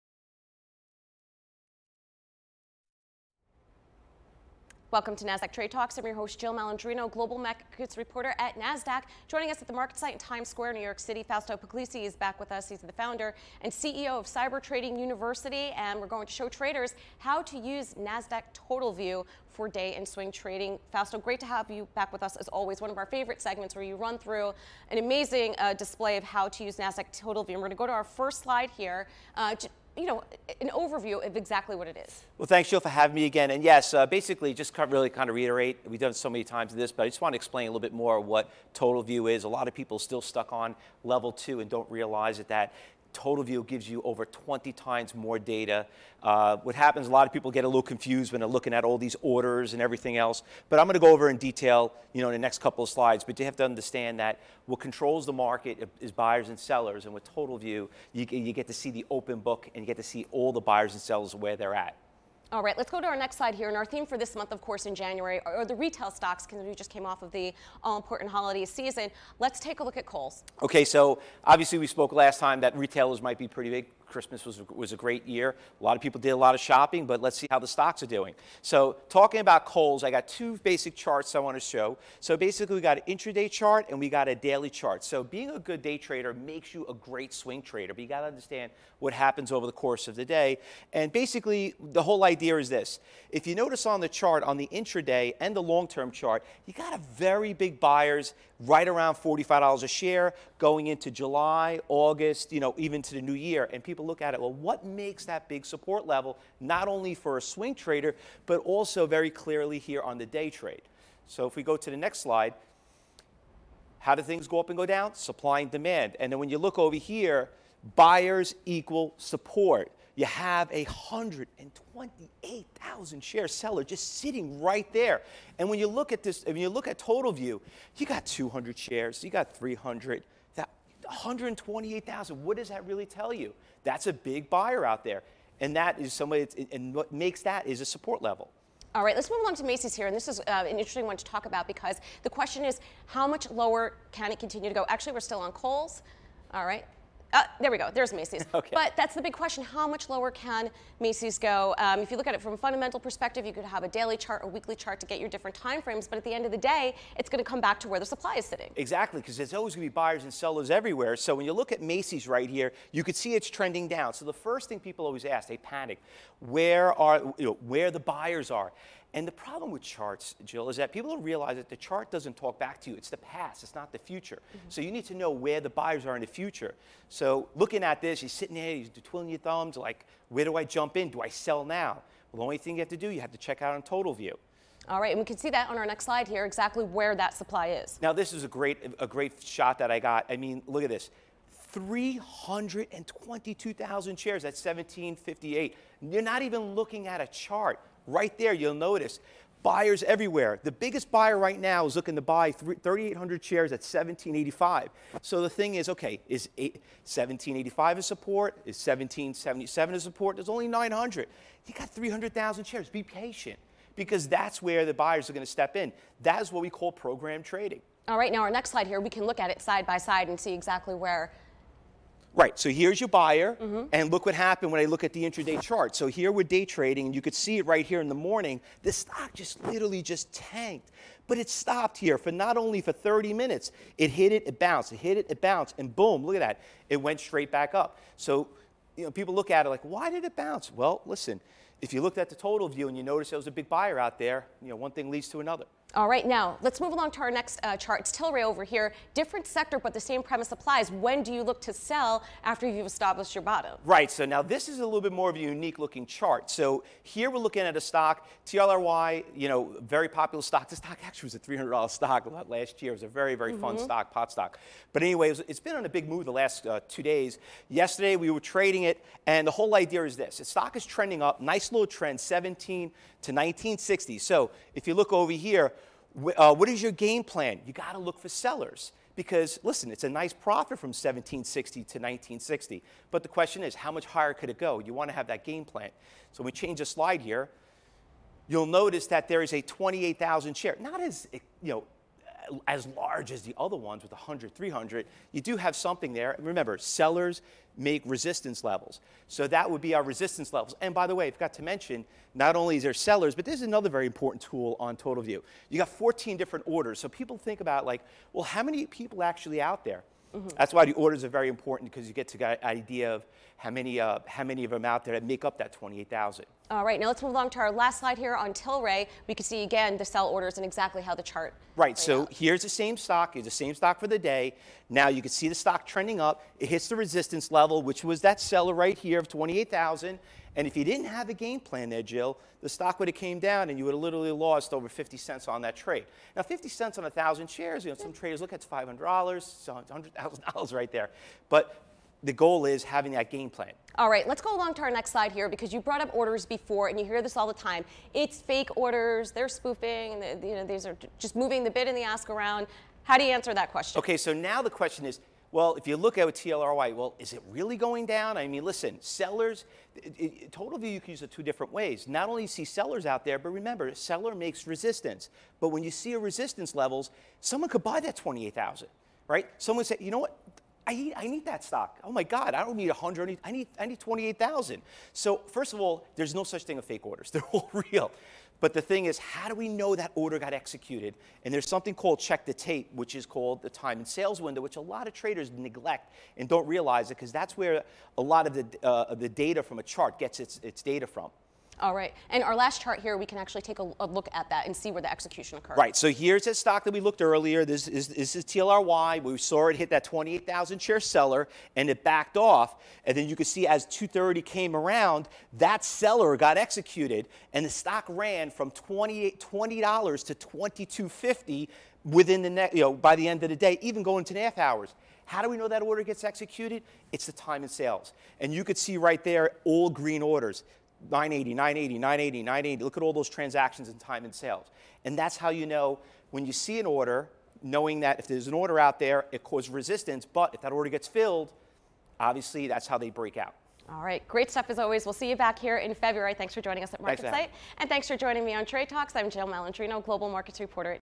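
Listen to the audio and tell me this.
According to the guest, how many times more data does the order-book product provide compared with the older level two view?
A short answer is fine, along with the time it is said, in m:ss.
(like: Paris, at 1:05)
20 times, at 0:44.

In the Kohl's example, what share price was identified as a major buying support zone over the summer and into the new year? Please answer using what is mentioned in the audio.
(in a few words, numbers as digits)
$45.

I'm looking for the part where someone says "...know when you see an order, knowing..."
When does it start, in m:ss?
7:05.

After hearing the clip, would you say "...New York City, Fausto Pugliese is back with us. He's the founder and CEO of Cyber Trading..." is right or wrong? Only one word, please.
right.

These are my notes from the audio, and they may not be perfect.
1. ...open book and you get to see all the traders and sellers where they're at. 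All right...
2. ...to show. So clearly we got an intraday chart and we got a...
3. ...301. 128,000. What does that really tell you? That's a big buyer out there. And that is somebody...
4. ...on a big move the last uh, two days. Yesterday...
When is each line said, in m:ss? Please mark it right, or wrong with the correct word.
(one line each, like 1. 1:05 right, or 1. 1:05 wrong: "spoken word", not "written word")
1. 0:59 wrong: "buyers", not "traders"
2. 1:21 wrong: "basically", not "clearly"
3. 2:09 wrong: "300", not "301"
4. 4:25 right.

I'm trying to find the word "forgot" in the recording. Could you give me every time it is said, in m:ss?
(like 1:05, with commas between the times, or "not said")
5:01.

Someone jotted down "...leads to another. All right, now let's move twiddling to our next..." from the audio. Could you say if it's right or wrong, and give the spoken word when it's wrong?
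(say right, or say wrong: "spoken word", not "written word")
wrong: "along", not "twiddling".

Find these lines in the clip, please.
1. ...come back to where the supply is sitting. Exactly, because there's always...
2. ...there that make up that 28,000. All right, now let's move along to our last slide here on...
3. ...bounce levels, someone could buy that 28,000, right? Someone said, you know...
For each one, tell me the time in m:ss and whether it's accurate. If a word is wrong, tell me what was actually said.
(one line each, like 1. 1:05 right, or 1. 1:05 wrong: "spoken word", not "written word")
1. 2:37 right
2. 5:15 right
3. 6:06 wrong: "resistance", not "bounce".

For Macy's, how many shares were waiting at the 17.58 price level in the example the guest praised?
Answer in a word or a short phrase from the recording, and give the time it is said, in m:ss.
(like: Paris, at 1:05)
322,000, at 3:11.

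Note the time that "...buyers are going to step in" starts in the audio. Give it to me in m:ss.
3:34.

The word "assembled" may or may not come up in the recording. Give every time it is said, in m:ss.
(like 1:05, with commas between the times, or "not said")
not said.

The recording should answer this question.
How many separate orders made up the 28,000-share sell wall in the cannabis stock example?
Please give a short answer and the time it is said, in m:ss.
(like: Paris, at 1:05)
14, at 5:05.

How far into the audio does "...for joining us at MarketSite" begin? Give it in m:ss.
7:16.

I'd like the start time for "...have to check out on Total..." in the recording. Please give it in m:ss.
3:03.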